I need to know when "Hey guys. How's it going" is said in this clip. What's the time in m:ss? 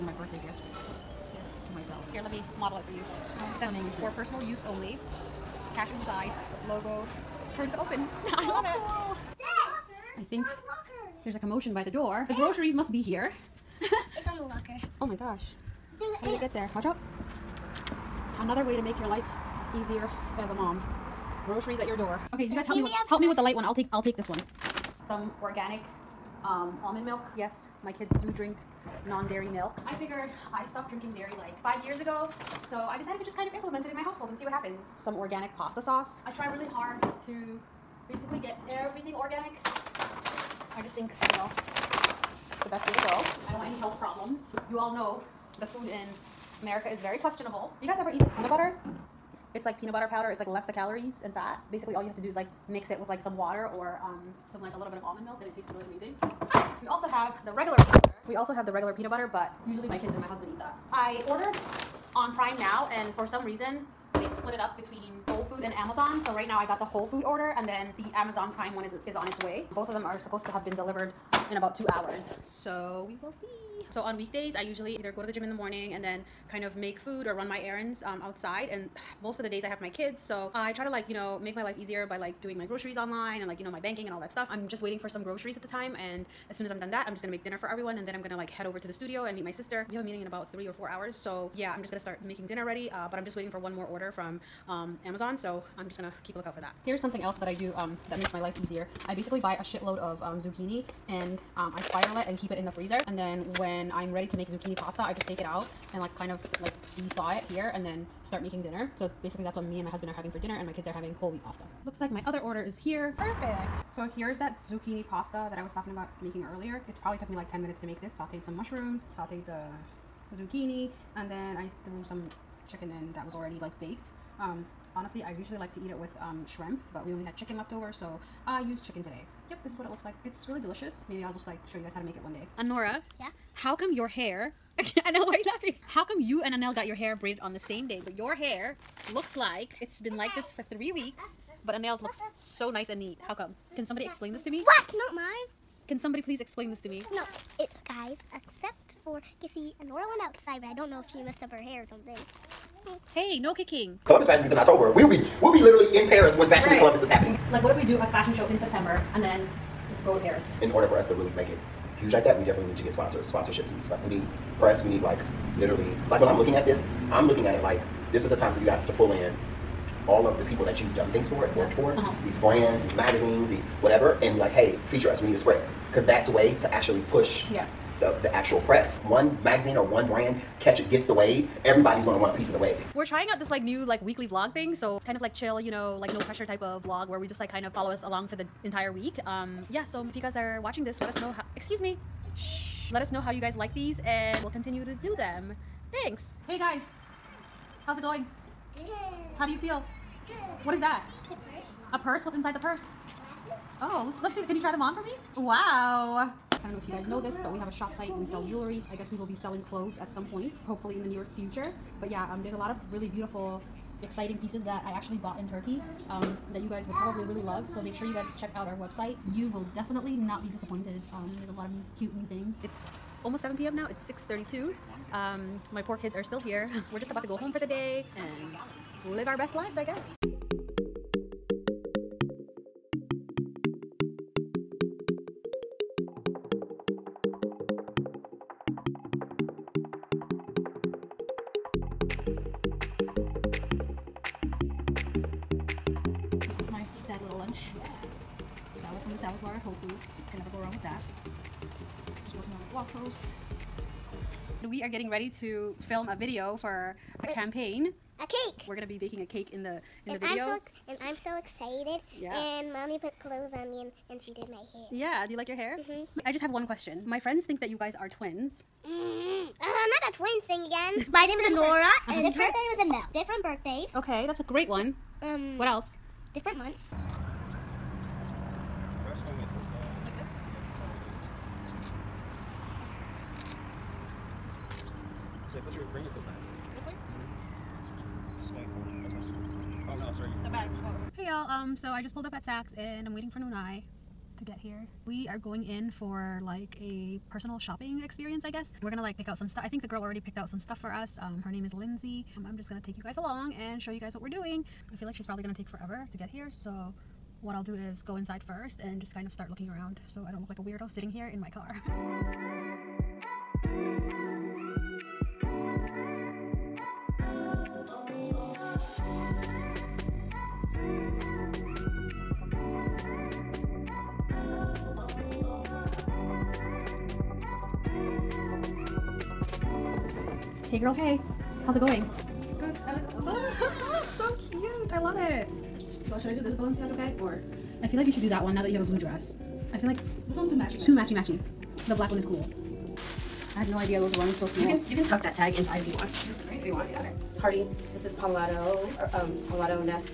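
3:16.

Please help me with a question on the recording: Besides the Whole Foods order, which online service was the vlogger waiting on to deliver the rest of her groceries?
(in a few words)
Amazon Prime.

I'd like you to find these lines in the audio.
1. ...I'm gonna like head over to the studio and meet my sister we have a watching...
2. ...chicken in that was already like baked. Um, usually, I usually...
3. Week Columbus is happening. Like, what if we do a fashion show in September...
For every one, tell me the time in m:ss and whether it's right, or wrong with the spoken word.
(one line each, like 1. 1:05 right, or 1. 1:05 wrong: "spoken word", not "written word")
1. 1:28 wrong: "meeting", not "watching"
2. 2:02 wrong: "honestly", not "usually"
3. 2:36 right.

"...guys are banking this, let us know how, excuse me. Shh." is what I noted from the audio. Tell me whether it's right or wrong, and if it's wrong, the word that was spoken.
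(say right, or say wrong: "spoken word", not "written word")
wrong: "watching", not "banking".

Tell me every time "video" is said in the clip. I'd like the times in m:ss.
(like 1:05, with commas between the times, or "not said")
4:16, 4:20.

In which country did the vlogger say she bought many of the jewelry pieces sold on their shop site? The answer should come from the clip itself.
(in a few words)
Turkey.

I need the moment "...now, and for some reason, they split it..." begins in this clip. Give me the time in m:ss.
1:02.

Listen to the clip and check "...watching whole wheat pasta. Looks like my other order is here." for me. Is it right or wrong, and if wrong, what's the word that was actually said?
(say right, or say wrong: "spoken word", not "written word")
wrong: "having", not "watching".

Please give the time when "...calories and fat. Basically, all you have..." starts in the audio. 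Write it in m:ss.
0:50.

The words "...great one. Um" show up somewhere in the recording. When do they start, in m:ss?
4:34.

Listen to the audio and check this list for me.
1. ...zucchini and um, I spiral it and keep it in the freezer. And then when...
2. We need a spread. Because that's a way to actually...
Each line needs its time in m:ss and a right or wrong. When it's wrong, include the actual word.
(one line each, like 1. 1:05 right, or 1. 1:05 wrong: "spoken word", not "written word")
1. 1:40 right
2. 2:55 right.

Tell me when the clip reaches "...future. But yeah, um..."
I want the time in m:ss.
3:31.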